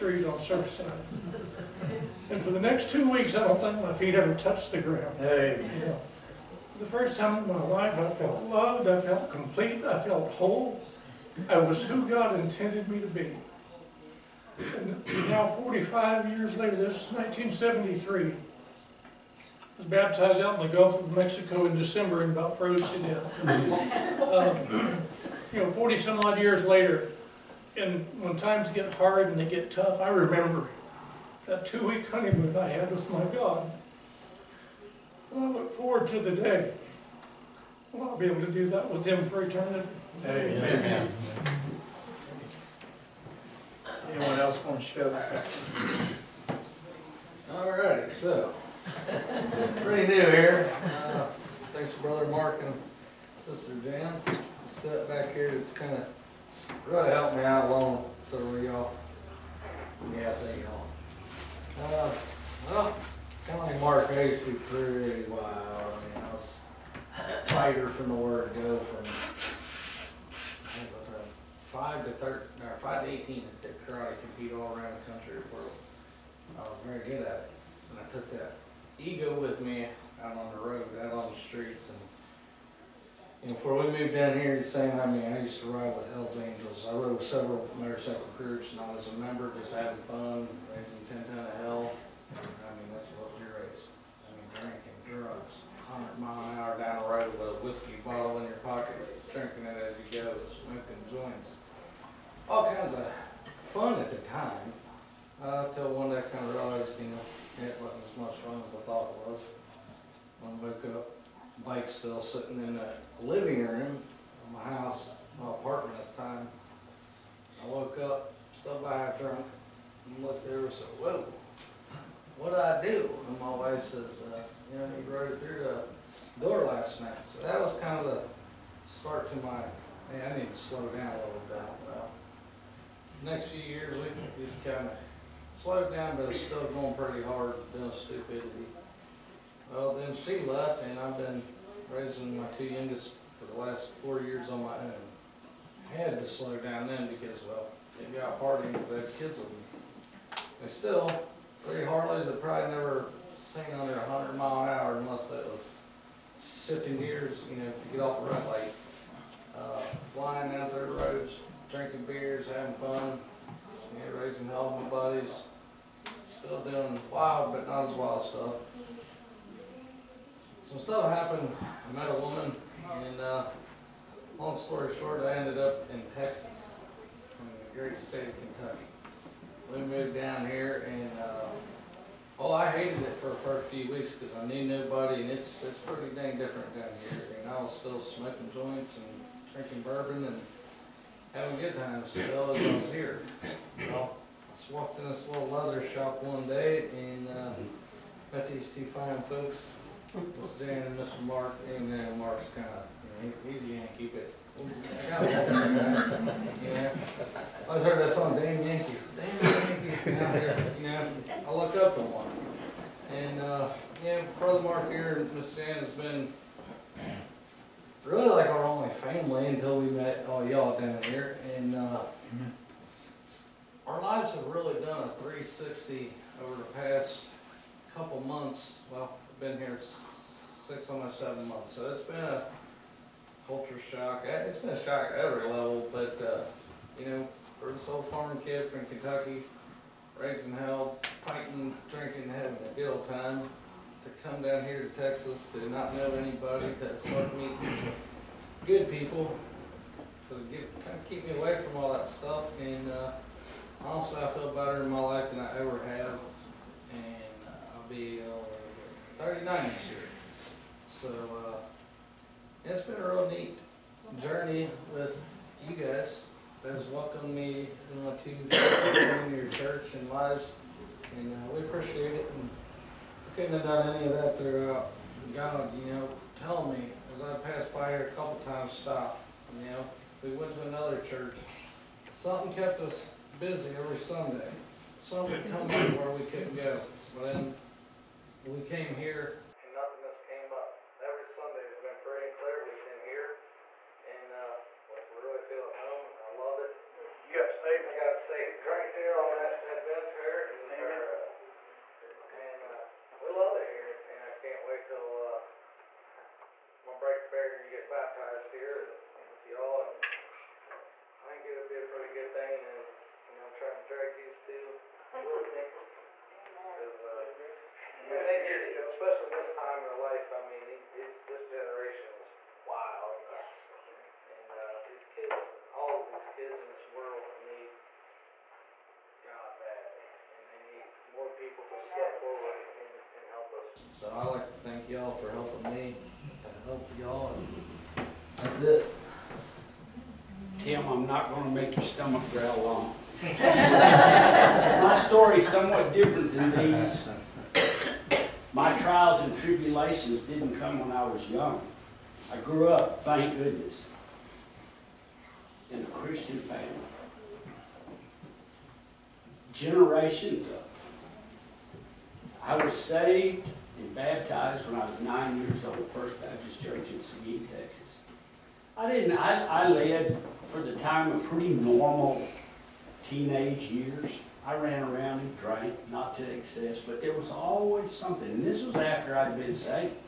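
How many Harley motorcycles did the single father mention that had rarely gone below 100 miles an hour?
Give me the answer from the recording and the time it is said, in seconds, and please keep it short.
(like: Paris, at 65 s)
3, at 151 s.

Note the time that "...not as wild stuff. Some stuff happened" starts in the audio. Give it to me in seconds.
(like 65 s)
167 s.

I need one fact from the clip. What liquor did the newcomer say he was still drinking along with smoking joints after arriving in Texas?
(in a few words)
Bourbon.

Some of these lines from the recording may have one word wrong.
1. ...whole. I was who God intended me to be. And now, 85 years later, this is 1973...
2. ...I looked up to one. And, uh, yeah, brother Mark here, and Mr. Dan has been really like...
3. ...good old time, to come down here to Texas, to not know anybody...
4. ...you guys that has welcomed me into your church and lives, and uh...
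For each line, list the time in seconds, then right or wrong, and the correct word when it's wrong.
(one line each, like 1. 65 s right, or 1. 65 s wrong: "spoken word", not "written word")
1. 10 s wrong: "45", not "85"
2. 211 s right
3. 242 s right
4. 265 s right.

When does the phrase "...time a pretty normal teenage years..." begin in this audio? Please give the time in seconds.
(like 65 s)
370 s.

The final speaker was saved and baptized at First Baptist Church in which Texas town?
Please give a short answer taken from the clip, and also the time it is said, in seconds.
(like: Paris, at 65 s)
Seguin, at 367 s.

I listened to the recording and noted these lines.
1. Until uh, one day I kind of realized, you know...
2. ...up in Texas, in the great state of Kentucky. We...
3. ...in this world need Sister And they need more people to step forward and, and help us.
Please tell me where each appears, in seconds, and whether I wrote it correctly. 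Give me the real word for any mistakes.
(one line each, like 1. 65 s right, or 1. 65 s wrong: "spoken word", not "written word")
1. 105 s right
2. 175 s right
3. 326 s wrong: "God", not "Sister".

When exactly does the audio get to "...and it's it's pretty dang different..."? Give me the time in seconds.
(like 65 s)
185 s.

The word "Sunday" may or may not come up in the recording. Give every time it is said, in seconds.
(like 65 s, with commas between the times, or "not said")
283 s, 291 s.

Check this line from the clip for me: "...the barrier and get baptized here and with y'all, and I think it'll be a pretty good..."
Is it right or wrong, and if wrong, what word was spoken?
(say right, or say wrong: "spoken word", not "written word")
right.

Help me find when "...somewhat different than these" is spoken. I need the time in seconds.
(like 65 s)
345 s.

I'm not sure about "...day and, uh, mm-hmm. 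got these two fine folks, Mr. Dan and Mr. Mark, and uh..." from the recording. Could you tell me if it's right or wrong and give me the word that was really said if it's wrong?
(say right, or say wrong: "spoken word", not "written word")
right.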